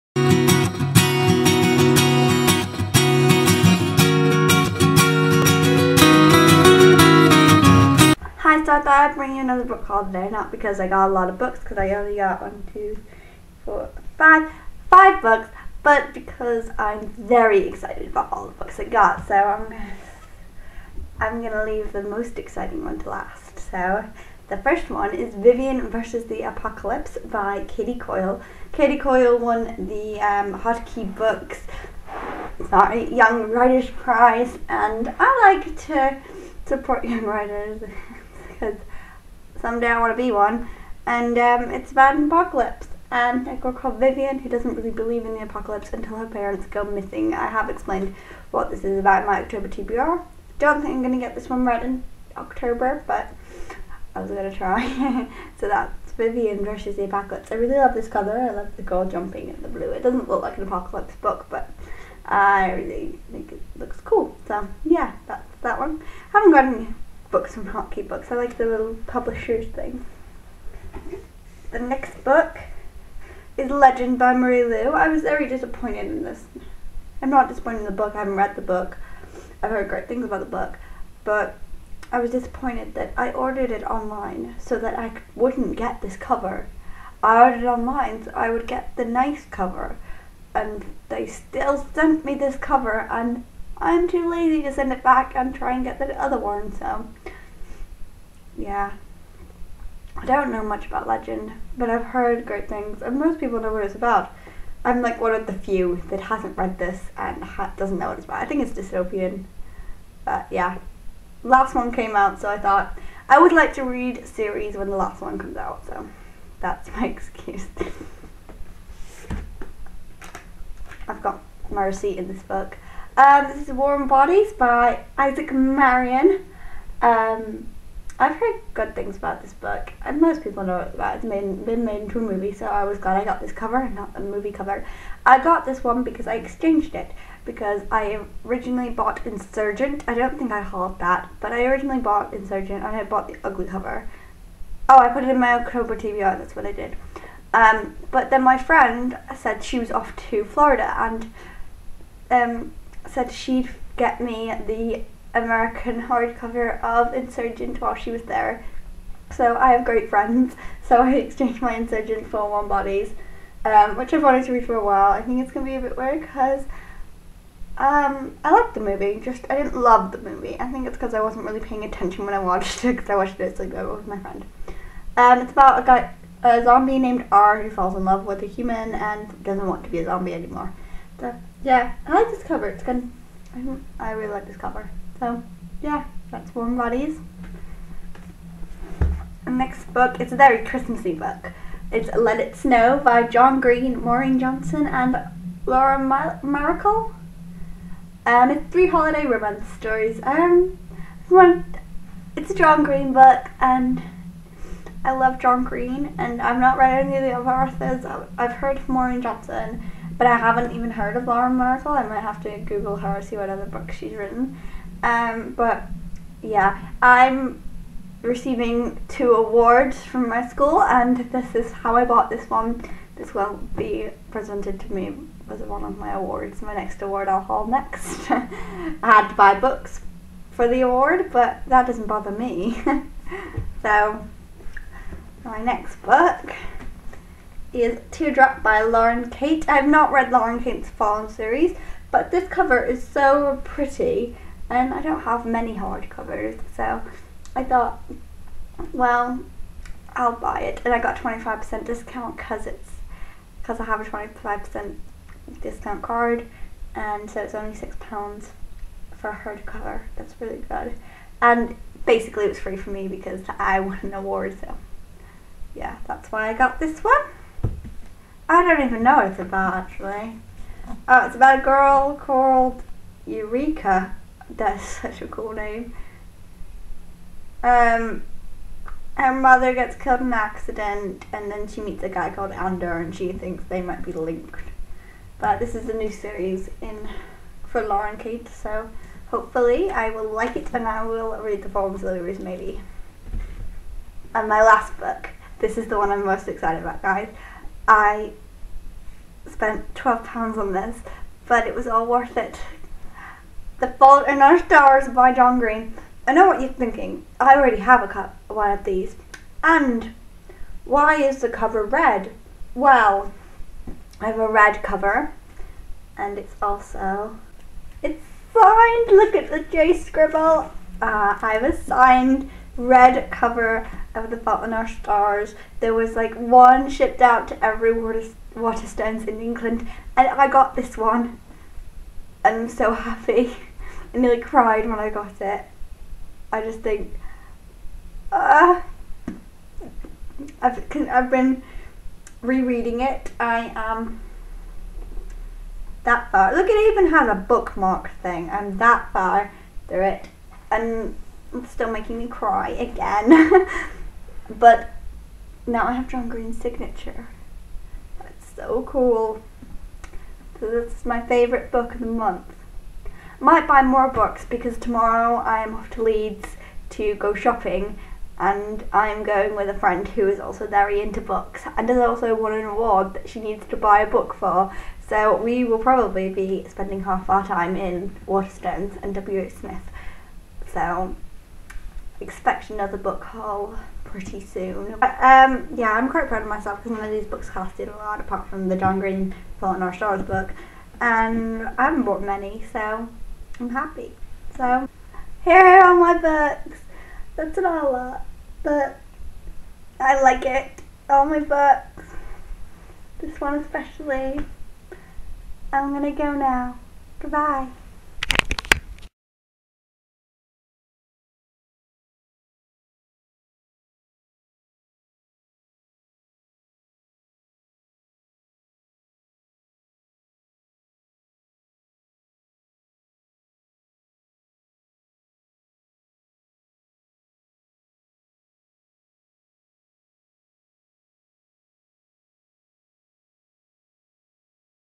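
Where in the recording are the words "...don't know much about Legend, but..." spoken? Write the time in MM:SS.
01:40.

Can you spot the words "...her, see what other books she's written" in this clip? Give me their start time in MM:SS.
03:32.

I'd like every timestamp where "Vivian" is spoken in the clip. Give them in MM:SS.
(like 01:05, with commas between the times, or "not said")
00:25, 00:43, 00:56.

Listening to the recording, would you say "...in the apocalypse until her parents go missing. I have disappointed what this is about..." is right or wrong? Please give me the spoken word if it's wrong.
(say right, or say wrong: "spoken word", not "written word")
wrong: "explained", not "disappointed".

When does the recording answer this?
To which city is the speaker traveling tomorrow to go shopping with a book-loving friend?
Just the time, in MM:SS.
06:06.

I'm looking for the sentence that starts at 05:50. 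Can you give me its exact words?
And it's still making me cry again.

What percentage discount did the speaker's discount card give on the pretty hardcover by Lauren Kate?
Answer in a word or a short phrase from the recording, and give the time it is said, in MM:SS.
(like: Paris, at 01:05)
25%, at 04:14.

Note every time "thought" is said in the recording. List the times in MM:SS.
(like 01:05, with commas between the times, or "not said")
00:08, 01:52, 04:07.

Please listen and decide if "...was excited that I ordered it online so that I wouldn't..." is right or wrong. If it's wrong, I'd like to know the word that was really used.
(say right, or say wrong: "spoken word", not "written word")
wrong: "disappointed", not "excited".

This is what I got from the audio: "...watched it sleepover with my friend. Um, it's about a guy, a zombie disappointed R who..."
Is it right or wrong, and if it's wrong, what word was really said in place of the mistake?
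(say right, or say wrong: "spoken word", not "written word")
wrong: "named", not "disappointed".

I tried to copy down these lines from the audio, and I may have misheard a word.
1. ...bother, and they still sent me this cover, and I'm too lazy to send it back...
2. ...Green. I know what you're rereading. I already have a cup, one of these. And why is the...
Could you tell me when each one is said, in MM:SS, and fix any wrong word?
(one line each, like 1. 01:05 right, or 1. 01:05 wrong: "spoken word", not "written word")
1. 01:29 wrong: "cover", not "bother"
2. 05:05 wrong: "thinking", not "rereading".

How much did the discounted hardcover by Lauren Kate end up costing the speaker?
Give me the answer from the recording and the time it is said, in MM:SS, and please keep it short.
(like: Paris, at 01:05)
£6, at 04:17.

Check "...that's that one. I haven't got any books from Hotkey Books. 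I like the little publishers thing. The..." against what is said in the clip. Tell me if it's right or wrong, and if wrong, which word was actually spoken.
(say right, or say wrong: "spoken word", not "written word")
right.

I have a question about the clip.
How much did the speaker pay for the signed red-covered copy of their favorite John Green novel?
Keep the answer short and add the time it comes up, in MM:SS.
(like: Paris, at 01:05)
£12, at 04:59.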